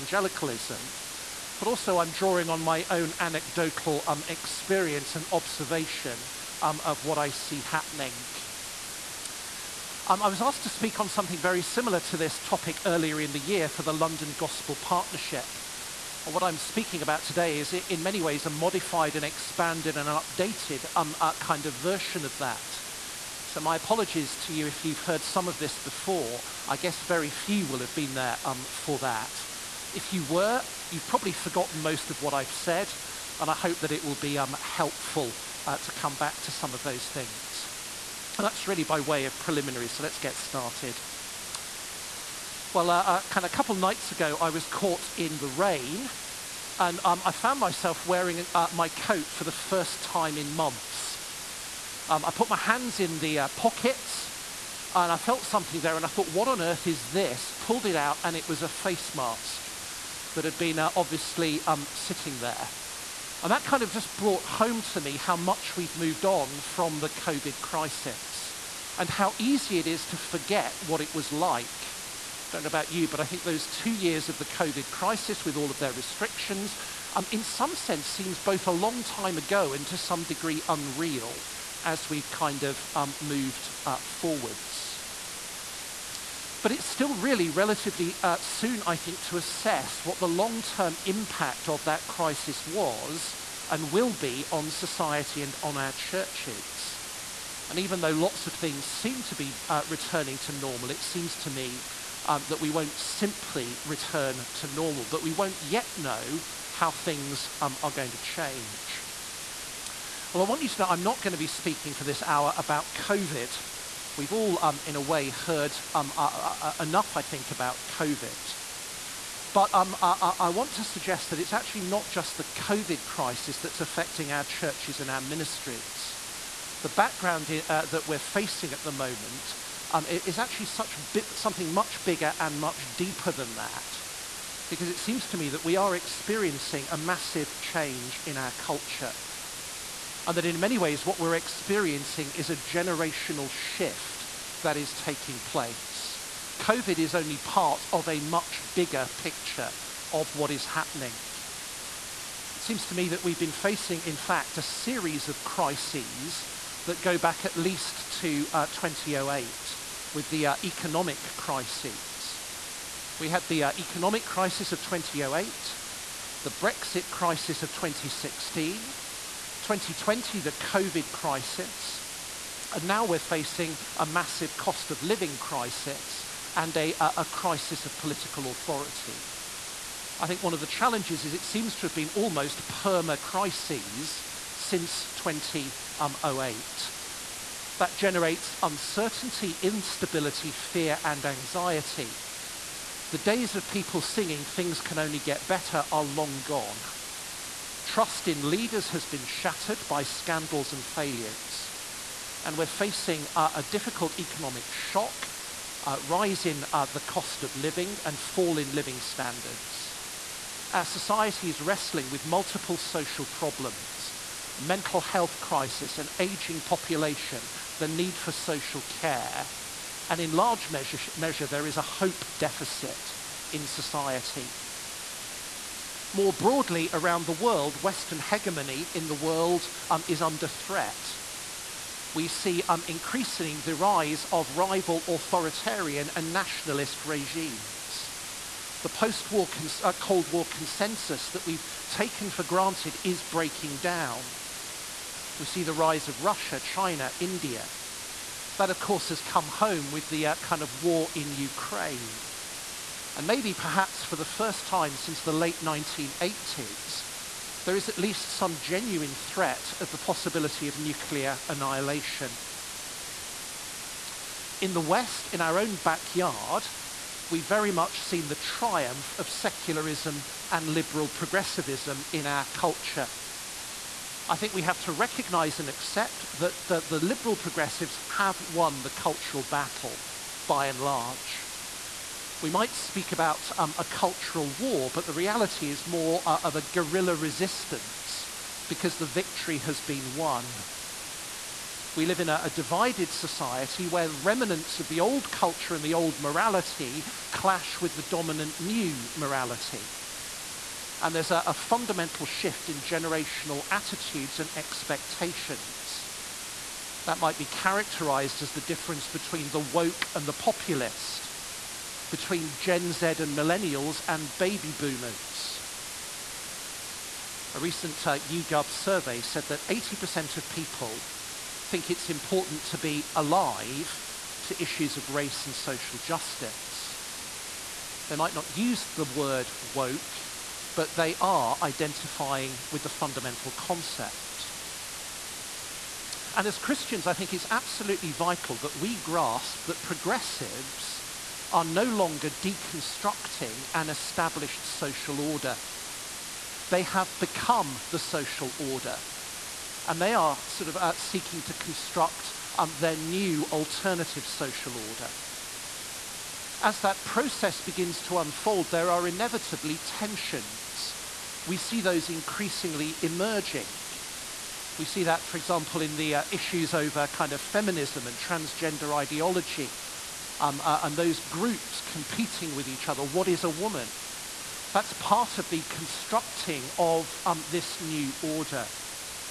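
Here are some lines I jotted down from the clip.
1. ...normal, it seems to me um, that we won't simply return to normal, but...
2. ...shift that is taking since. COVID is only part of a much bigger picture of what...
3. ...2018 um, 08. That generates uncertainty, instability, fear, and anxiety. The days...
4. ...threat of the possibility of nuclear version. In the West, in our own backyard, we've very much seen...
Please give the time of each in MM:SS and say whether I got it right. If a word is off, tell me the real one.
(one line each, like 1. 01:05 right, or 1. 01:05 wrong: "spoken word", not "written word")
1. 01:40 right
2. 02:23 wrong: "place", not "since"
3. 03:05 right
4. 04:19 wrong: "annihilation", not "version".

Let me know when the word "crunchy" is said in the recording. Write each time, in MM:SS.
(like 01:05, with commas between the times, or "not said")
not said.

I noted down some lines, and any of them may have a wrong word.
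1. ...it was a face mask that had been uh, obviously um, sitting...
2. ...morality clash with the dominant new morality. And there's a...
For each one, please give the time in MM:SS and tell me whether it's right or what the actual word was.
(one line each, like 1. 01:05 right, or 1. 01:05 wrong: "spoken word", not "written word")
1. 00:58 right
2. 04:56 right.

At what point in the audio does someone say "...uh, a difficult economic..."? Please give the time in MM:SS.
03:23.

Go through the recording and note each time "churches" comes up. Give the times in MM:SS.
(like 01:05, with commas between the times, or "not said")
01:35, 02:04.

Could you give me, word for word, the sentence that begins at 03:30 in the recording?
Our society is wrestling with multiple social problems a mental health crisis, an aging population, the need for social care.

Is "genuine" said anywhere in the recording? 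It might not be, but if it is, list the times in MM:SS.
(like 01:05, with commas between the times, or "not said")
04:18.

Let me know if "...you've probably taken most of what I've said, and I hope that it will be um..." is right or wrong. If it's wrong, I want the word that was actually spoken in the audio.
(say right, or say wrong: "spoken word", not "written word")
wrong: "forgotten", not "taken".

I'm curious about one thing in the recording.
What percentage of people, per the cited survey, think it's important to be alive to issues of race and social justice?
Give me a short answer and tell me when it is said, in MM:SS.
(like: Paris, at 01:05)
80%, at 05:19.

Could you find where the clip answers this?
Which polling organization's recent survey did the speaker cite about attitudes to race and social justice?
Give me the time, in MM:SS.
05:18.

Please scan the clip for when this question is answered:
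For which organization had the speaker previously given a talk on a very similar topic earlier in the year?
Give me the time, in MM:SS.
00:13.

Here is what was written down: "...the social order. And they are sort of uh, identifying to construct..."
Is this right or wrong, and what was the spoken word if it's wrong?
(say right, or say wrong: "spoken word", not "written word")
wrong: "seeking", not "identifying".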